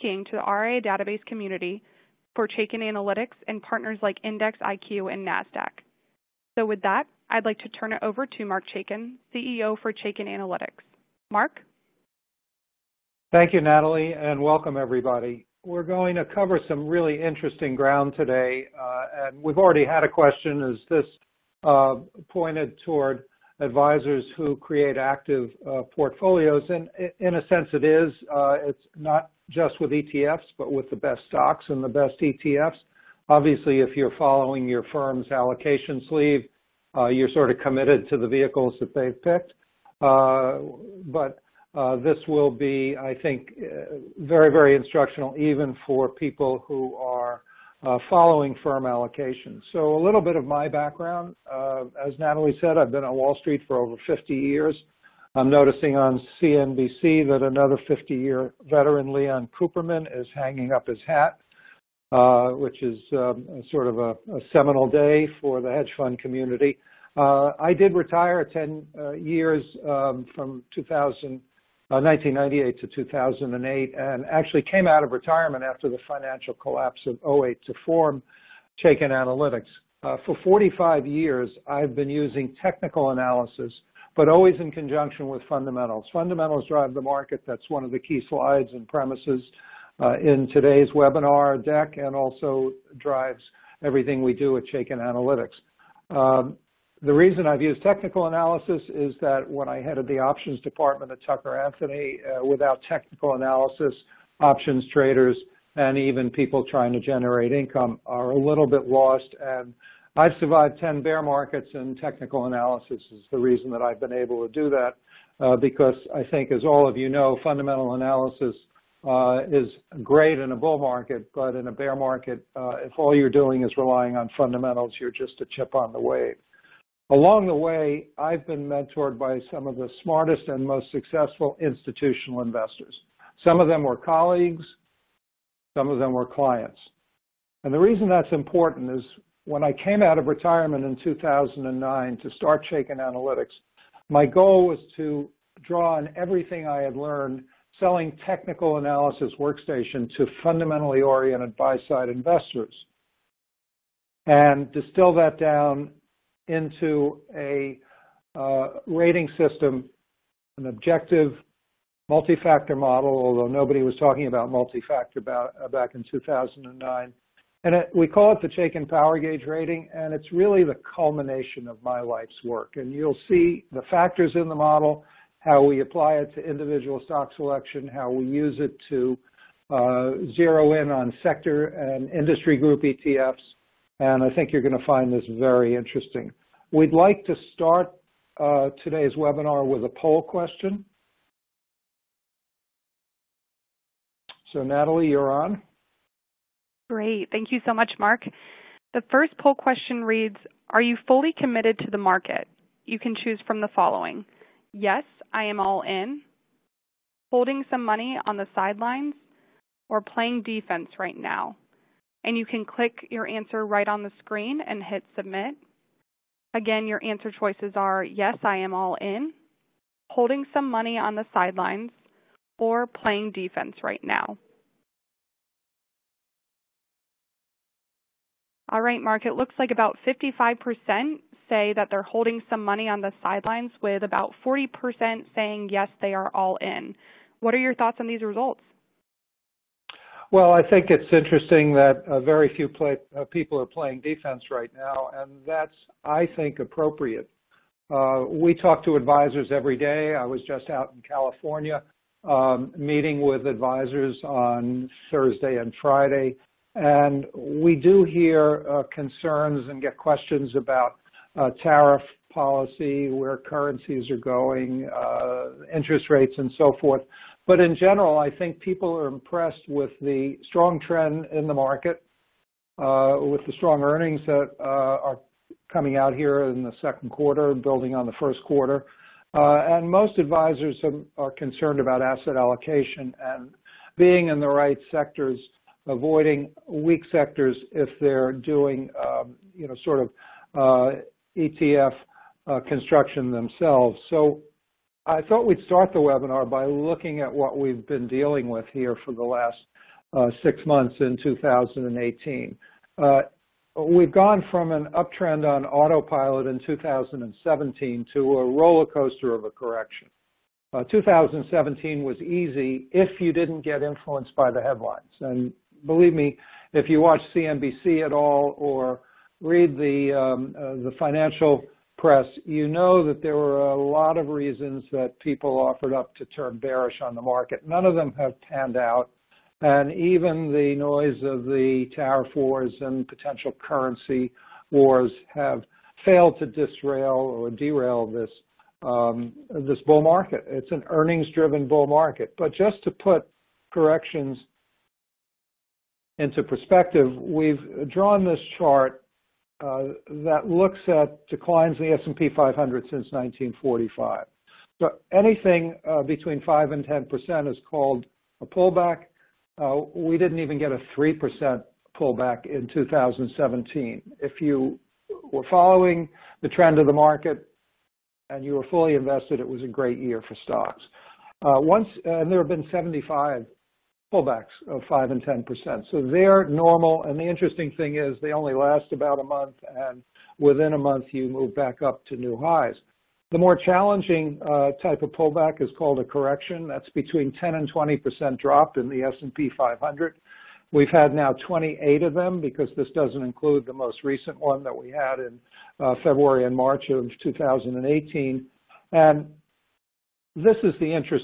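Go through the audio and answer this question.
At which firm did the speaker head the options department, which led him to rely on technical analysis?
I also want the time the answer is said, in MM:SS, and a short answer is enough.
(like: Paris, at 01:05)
Tucker Anthony, at 01:41.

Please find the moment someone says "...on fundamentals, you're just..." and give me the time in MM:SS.
02:04.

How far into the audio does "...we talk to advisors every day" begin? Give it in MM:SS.
04:08.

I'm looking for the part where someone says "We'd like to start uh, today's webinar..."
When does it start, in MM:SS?
03:06.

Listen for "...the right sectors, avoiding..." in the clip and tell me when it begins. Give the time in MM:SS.
04:44.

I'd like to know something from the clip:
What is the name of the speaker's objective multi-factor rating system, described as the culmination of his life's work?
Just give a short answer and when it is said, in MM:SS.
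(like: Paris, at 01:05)
Chaikin Power Gauge, at 02:48.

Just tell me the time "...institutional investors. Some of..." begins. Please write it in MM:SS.
02:11.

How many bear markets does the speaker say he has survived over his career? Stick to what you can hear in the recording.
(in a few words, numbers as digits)
10.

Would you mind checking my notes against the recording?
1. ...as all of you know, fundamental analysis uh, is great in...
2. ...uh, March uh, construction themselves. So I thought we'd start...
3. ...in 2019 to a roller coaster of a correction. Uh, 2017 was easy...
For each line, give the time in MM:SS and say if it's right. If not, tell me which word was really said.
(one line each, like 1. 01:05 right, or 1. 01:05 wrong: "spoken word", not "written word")
1. 01:56 right
2. 04:50 wrong: "ETF", not "March"
3. 05:06 wrong: "2017", not "2019".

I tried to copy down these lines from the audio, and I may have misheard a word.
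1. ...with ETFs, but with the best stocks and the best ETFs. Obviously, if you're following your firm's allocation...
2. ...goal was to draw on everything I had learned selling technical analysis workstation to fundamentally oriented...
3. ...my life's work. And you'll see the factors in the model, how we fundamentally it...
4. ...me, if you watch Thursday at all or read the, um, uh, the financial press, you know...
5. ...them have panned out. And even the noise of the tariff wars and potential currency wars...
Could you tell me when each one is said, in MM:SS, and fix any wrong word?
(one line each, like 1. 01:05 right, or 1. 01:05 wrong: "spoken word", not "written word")
1. 00:29 right
2. 02:24 right
3. 02:51 wrong: "apply", not "fundamentally"
4. 05:16 wrong: "CNBC", not "Thursday"
5. 05:27 right.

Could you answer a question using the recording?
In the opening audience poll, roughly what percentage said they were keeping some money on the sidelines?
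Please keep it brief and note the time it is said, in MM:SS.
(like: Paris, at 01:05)
55%, at 03:50.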